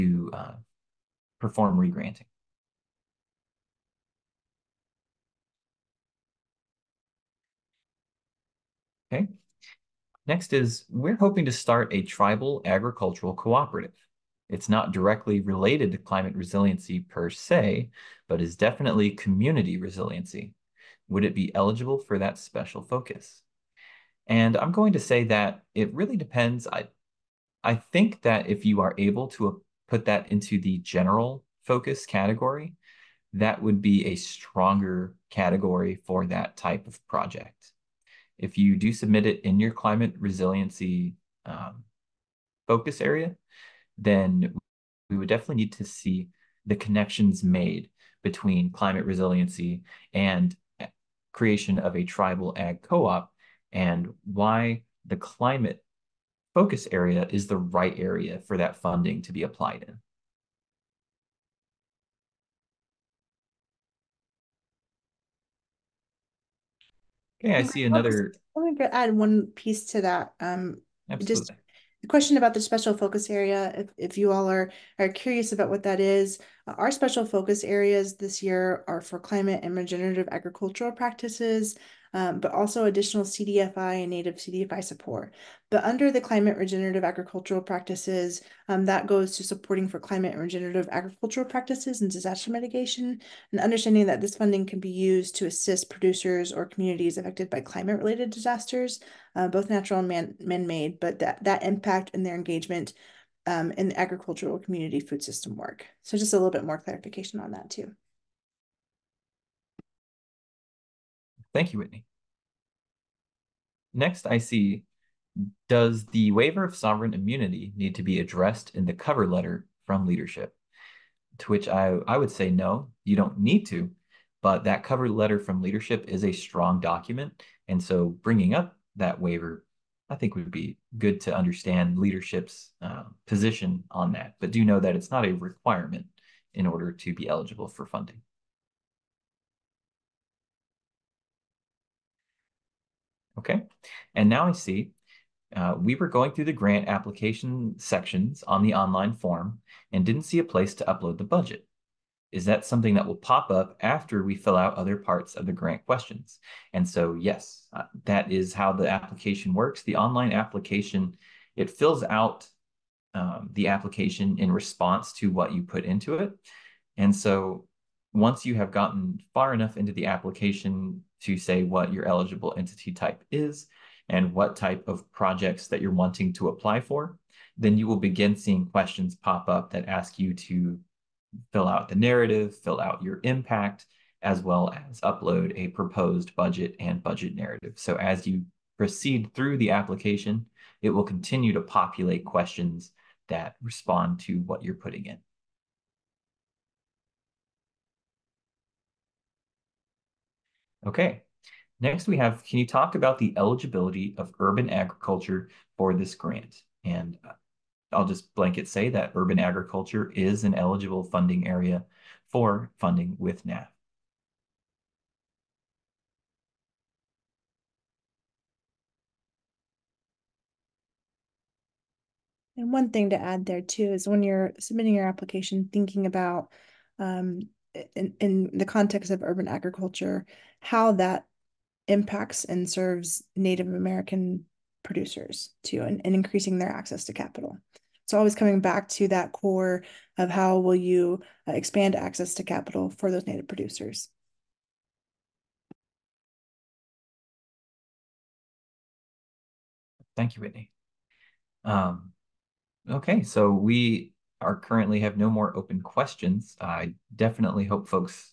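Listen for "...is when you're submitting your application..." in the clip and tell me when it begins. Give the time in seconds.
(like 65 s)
223 s.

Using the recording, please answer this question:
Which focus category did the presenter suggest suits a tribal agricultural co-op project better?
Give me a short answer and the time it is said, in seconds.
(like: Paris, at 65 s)
General focus, at 30 s.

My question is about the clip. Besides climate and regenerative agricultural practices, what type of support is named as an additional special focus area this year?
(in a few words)
Native CDFI support.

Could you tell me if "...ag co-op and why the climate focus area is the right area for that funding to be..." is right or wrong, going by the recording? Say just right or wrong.
right.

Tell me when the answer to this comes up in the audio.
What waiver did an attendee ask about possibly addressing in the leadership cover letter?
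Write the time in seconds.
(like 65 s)
116 s.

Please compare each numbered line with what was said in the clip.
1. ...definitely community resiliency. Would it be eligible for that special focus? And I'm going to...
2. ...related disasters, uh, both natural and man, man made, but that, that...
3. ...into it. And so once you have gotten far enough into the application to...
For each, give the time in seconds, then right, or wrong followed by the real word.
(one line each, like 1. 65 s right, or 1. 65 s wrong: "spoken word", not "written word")
1. 18 s right
2. 97 s right
3. 165 s right.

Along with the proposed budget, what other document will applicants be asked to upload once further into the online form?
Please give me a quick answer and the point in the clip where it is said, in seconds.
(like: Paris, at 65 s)
Budget narrative, at 187 s.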